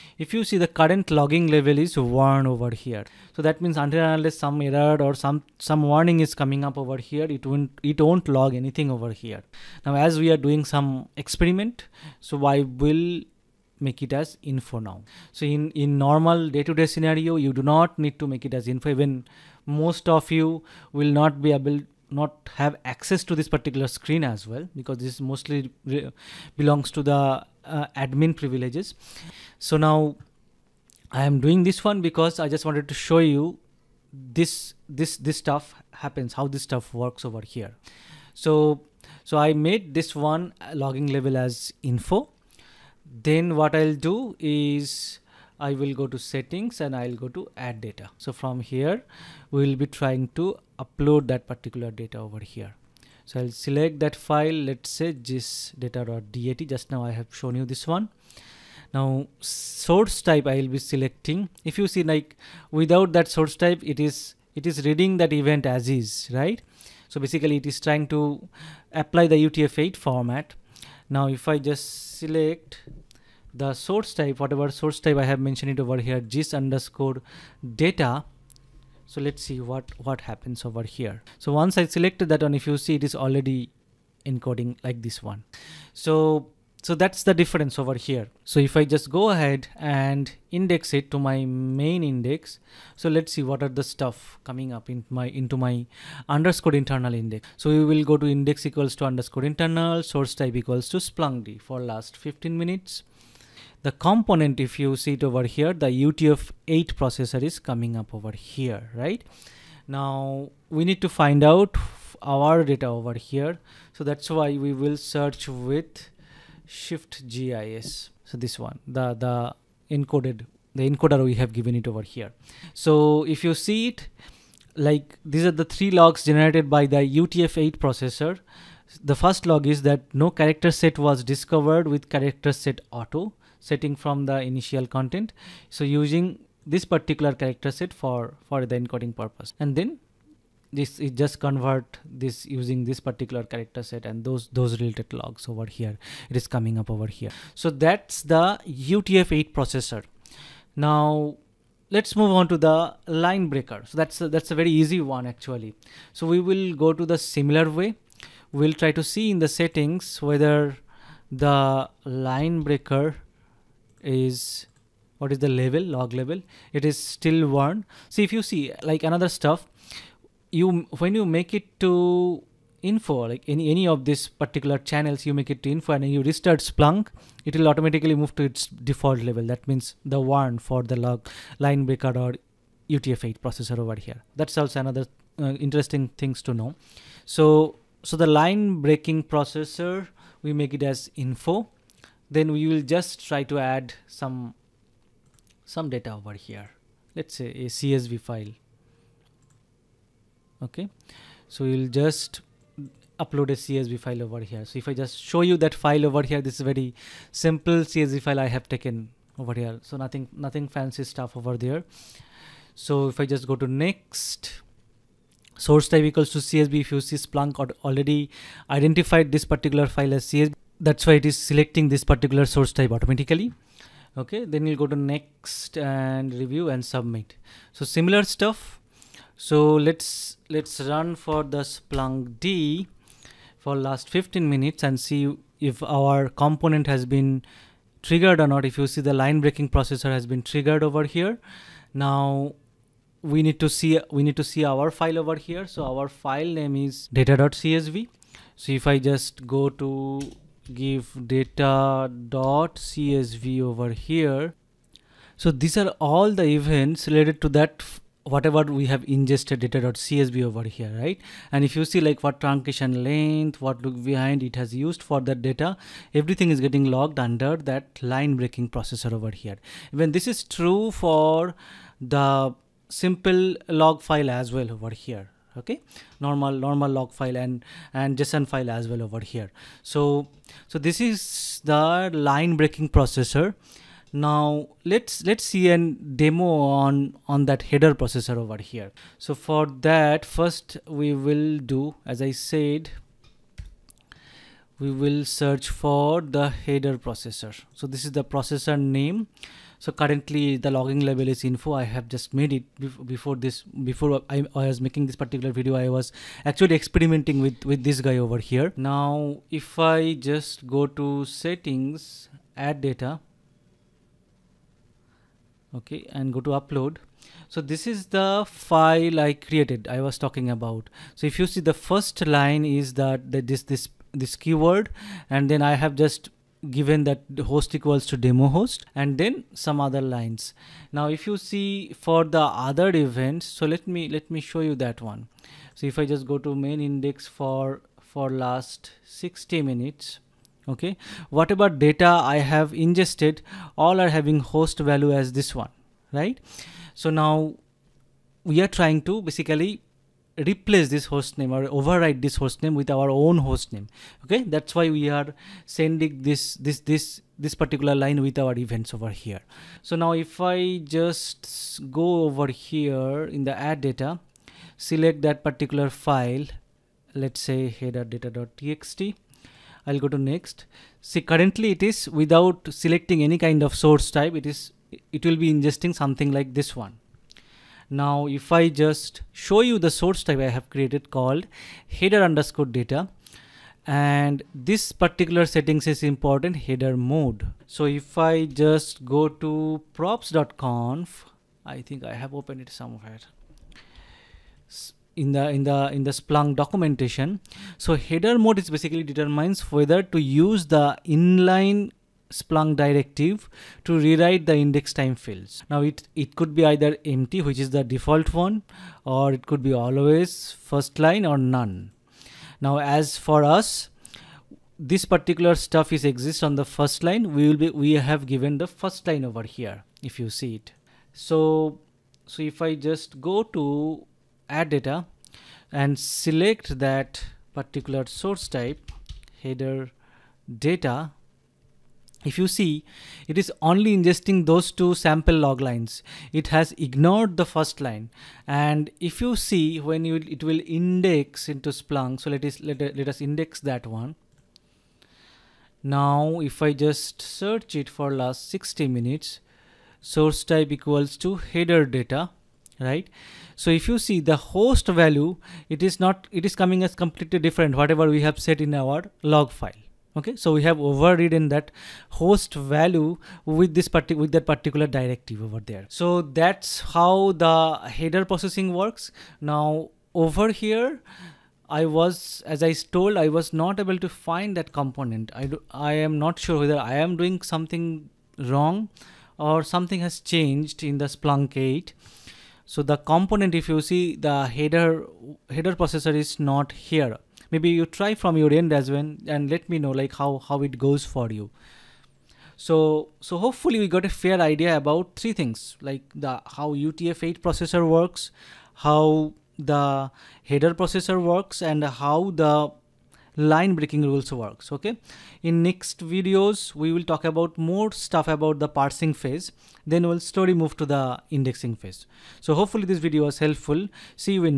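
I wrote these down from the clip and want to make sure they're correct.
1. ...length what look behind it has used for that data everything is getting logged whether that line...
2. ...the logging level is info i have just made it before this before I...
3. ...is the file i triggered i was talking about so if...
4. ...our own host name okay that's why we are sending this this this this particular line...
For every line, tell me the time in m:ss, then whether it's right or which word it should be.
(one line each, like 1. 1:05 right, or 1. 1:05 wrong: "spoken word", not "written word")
1. 4:23 wrong: "under", not "whether"
2. 5:00 right
3. 5:17 wrong: "created", not "triggered"
4. 5:52 right.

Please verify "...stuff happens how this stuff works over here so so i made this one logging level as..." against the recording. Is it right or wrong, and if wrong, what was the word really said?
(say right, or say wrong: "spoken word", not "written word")
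right.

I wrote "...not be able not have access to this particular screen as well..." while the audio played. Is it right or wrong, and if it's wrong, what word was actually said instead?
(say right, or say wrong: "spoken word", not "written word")
right.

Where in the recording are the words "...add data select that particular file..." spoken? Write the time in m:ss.
6:03.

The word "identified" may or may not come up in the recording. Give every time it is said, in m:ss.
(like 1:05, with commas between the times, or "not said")
3:38.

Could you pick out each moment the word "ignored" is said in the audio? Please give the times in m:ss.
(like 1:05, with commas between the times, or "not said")
7:16.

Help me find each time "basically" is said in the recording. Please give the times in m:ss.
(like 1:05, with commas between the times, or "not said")
1:07, 5:49, 6:38.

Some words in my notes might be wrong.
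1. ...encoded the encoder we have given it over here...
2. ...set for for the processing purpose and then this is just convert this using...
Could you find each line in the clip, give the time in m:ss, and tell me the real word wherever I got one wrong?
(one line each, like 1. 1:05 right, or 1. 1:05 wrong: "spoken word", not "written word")
1. 1:59 right
2. 2:17 wrong: "encoding", not "processing".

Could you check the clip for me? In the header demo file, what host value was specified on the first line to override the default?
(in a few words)
demo host.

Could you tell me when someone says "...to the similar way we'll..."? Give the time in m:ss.
2:36.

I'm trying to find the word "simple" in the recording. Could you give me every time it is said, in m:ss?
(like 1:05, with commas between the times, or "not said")
3:27, 4:32.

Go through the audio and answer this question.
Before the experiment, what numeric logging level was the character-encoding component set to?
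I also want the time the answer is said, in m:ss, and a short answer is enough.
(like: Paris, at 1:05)
1, at 0:01.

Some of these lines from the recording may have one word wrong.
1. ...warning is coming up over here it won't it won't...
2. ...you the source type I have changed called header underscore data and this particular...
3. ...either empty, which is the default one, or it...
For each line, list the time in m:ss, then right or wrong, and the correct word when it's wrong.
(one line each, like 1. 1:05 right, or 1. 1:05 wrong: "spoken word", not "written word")
1. 0:05 right
2. 6:19 wrong: "created", not "changed"
3. 6:46 right.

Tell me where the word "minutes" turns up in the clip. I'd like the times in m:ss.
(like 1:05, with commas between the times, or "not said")
1:42, 3:54, 5:39, 7:28.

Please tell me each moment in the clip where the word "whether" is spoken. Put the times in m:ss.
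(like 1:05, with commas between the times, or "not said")
2:40, 6:39, 7:56.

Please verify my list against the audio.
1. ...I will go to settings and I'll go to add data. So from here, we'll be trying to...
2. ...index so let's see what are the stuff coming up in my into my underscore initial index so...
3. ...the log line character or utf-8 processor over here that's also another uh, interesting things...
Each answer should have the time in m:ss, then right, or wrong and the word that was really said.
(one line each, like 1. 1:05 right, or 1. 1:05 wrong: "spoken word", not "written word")
1. 0:45 right
2. 1:32 wrong: "internal", not "initial"
3. 3:00 wrong: "breaker", not "character".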